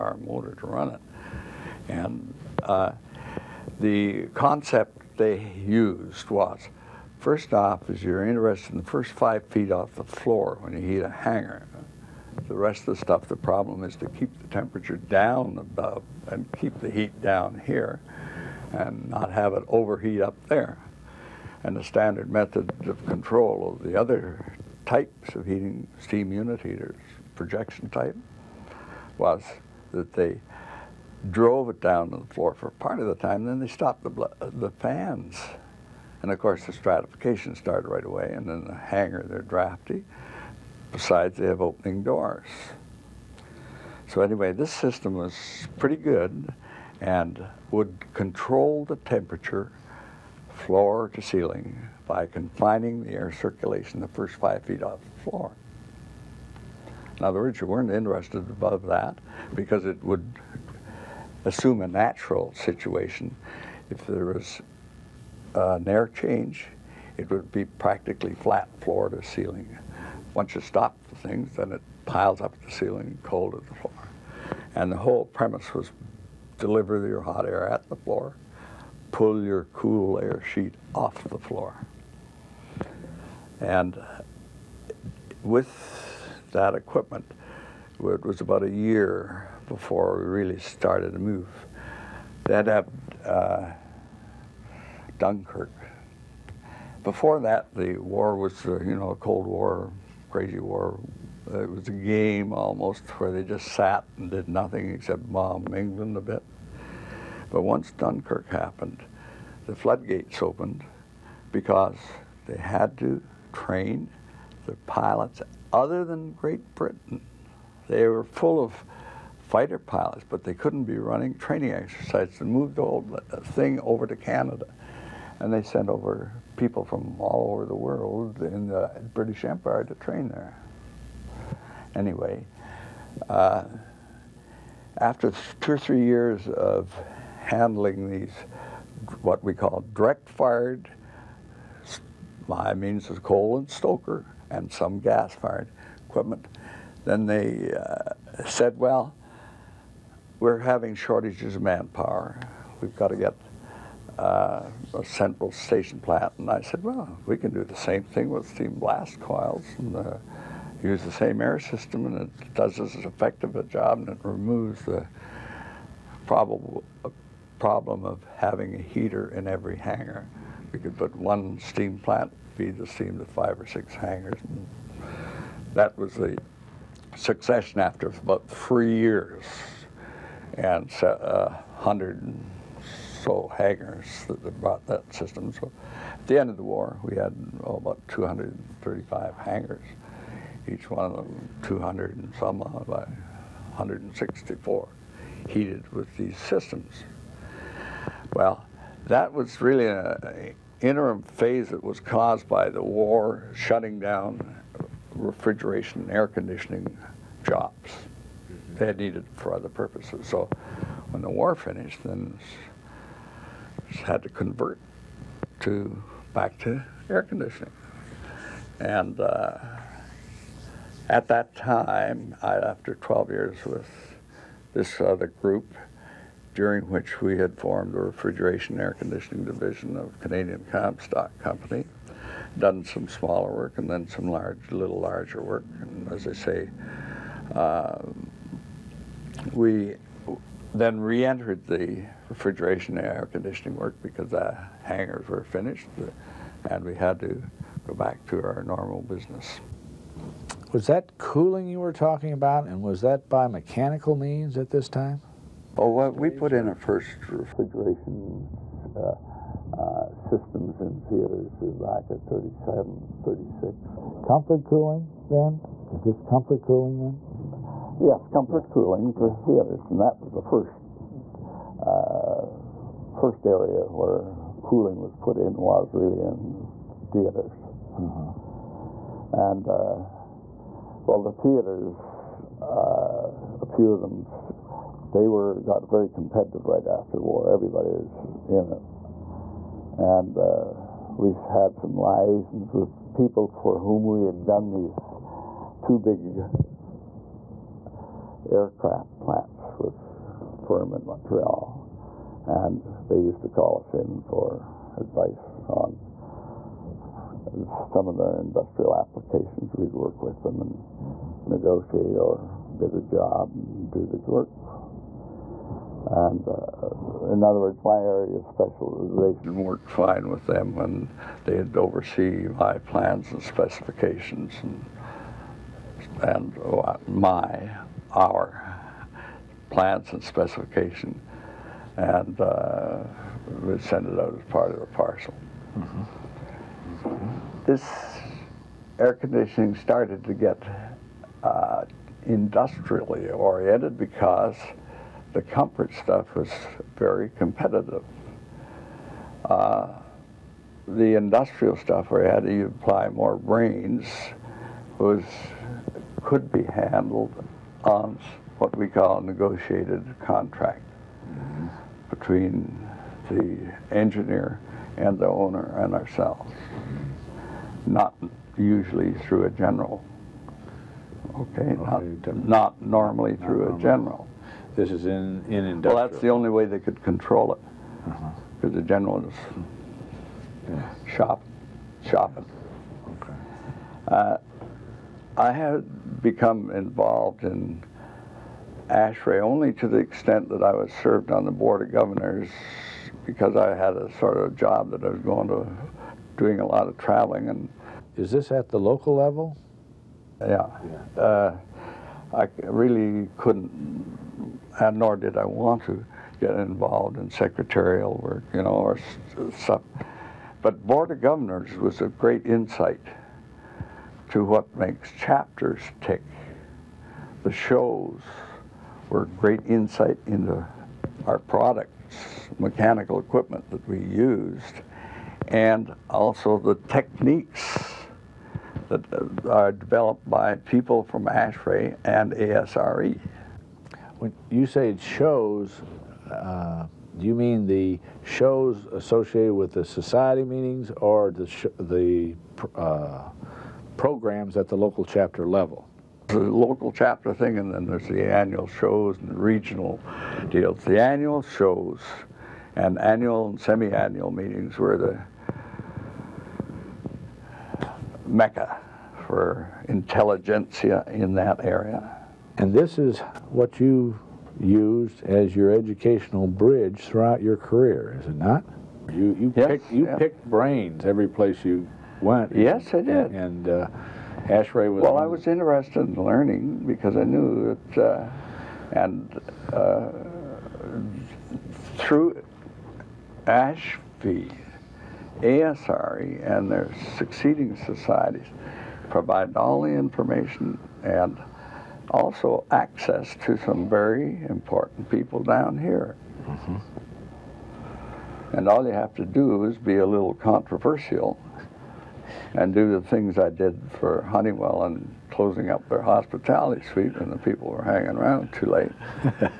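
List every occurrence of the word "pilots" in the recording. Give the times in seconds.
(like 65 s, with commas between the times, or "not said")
114 s, 119 s.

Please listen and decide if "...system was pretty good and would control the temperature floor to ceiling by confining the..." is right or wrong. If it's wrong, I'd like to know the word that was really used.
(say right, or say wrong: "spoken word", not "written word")
right.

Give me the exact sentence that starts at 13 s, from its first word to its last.
The problem is to keep the temperature down above and keep the heat down here and not have it overheat up there.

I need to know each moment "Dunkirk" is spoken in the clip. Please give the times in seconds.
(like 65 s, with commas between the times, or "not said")
95 s, 107 s.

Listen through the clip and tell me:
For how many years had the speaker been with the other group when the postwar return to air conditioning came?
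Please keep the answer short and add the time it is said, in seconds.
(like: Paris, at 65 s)
12, at 222 s.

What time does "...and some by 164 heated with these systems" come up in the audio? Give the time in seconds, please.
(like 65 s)
192 s.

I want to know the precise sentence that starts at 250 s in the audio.
Was that cooling you were talking about and was that by mechanical means at this time?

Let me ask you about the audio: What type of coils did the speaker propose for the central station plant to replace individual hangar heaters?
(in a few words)
steam blast coils.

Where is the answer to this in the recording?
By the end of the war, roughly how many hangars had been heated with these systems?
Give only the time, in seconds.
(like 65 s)
188 s.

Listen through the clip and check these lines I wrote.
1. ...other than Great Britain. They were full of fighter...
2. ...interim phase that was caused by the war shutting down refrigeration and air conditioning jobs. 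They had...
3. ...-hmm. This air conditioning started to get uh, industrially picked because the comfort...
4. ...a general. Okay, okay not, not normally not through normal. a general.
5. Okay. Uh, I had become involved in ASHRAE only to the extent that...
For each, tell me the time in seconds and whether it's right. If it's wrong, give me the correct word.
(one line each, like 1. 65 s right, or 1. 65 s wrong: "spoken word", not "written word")
1. 115 s right
2. 200 s right
3. 335 s wrong: "oriented", not "picked"
4. 369 s right
5. 383 s right.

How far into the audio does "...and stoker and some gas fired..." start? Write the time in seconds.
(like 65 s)
143 s.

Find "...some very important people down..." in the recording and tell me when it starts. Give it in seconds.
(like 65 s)
493 s.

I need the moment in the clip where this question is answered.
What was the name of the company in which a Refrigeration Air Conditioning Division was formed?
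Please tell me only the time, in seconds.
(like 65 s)
230 s.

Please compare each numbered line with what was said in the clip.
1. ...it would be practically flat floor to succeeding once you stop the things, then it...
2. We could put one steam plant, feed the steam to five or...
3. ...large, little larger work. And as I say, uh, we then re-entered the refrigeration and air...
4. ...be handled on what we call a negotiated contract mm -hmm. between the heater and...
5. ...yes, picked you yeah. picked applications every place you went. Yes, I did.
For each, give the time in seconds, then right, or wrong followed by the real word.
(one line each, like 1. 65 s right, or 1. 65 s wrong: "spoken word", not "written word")
1. 67 s wrong: "ceiling", not "succeeding"
2. 170 s right
3. 234 s right
4. 356 s wrong: "engineer", not "heater"
5. 469 s wrong: "brains", not "applications".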